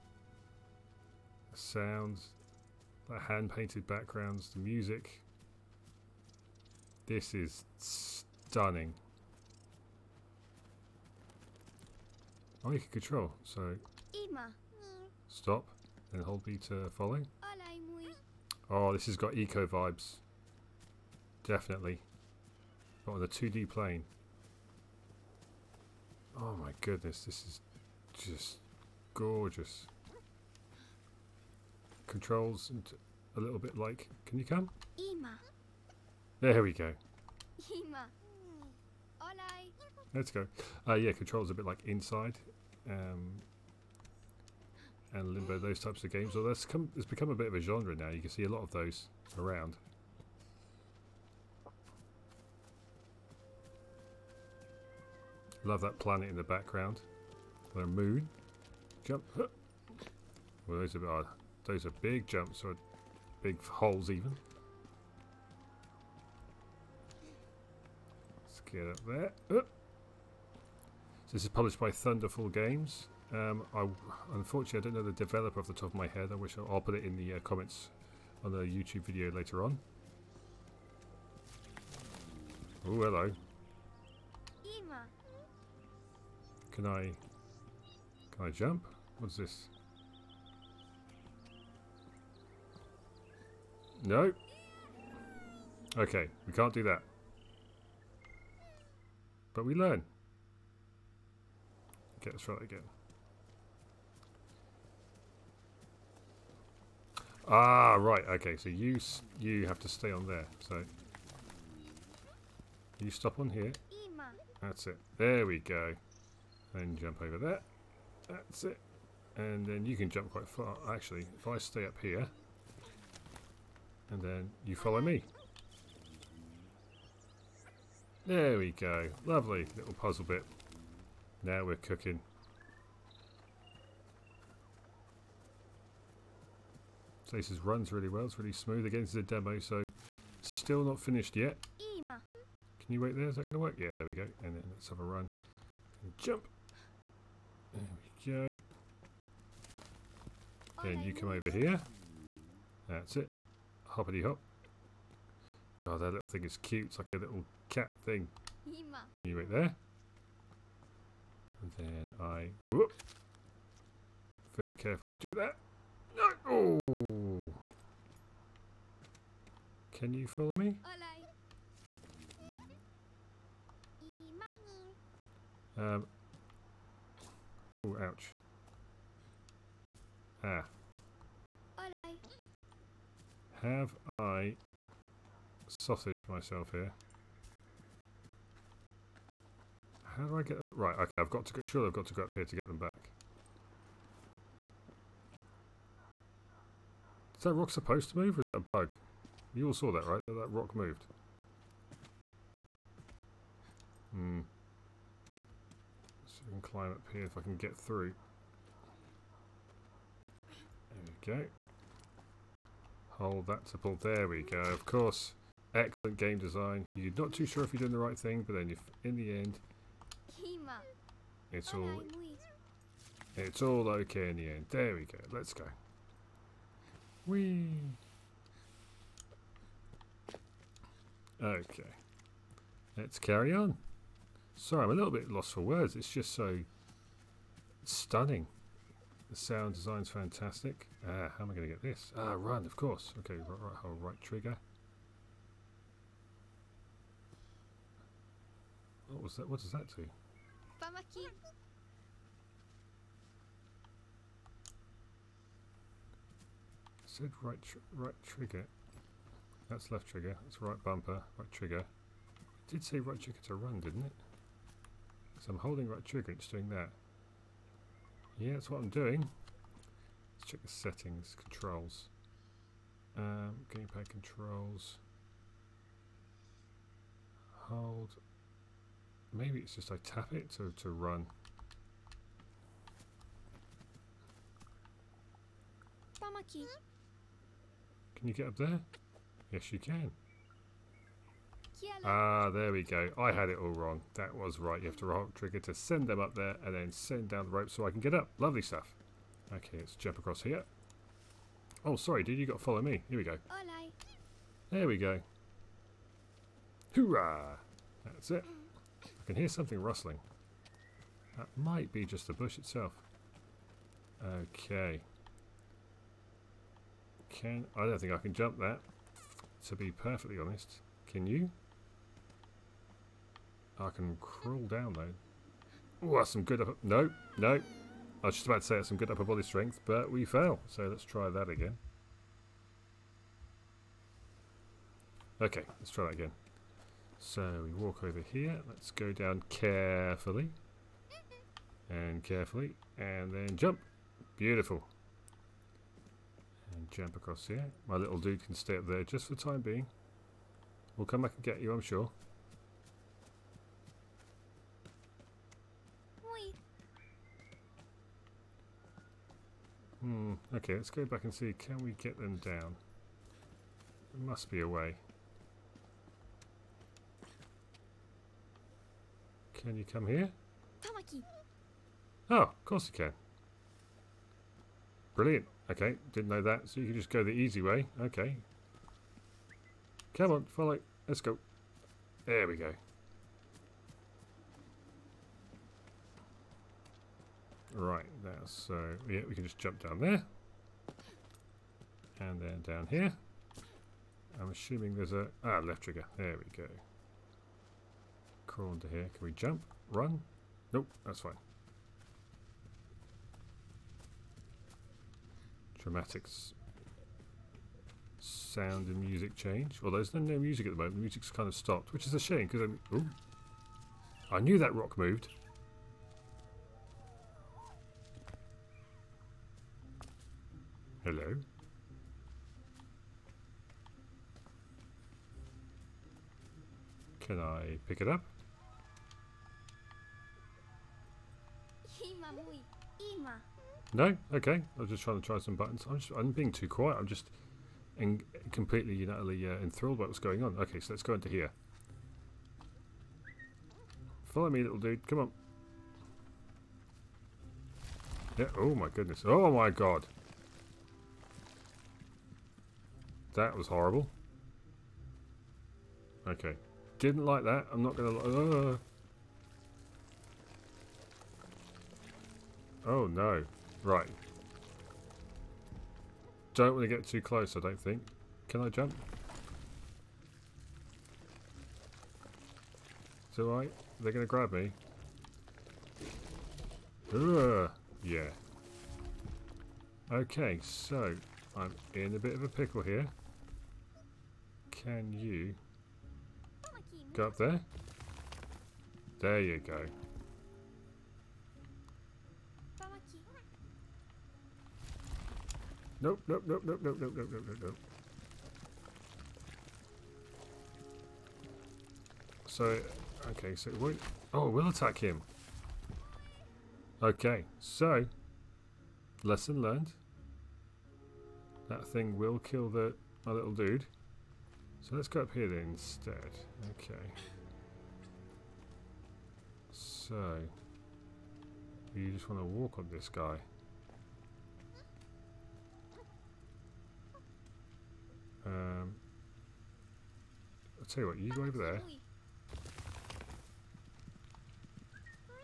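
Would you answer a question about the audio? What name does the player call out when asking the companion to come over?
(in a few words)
Tamaki.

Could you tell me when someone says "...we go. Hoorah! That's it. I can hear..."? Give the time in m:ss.
5:04.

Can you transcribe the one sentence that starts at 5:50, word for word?
We'll come back and get you, I'm sure.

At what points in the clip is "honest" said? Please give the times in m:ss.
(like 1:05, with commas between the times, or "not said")
5:20.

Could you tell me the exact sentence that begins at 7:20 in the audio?
Okay, so let's go into here.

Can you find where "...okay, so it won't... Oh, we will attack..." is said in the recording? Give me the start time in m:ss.
8:23.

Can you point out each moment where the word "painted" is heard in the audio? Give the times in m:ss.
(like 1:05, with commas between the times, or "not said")
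0:03.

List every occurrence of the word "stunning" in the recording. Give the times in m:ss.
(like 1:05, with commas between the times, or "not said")
0:07, 3:57.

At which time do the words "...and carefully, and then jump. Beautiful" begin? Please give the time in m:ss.
5:41.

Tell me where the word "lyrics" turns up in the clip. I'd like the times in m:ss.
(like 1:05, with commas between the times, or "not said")
not said.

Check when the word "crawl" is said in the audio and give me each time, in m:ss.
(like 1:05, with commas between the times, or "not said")
5:24, 6:38.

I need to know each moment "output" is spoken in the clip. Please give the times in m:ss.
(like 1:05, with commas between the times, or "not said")
not said.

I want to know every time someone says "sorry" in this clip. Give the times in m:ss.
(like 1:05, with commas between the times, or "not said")
3:54, 5:01.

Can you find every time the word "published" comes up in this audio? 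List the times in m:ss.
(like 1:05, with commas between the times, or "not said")
1:11.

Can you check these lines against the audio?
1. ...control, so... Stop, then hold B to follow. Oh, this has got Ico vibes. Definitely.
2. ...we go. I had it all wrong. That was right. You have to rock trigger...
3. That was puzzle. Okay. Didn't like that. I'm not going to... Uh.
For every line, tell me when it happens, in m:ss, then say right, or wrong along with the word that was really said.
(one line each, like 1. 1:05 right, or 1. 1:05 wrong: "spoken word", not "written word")
1. 0:12 right
2. 4:52 right
3. 7:33 wrong: "horrible", not "puzzle".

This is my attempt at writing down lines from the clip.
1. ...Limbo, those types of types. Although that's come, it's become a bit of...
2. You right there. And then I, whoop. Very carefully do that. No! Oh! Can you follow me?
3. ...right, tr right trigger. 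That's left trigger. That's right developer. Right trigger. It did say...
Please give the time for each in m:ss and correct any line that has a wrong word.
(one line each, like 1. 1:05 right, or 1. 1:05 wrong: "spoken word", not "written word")
1. 0:45 wrong: "games", not "types"
2. 2:39 right
3. 4:17 wrong: "bumper", not "developer".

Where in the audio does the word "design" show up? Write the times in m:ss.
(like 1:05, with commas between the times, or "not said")
3:36, 3:59.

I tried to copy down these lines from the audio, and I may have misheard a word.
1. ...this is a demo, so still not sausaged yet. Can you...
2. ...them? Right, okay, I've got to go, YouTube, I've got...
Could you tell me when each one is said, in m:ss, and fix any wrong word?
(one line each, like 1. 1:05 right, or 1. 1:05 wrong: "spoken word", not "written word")
1. 2:19 wrong: "finished", not "sausaged"
2. 3:10 wrong: "Sure", not "YouTube".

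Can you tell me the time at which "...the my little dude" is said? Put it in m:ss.
8:32.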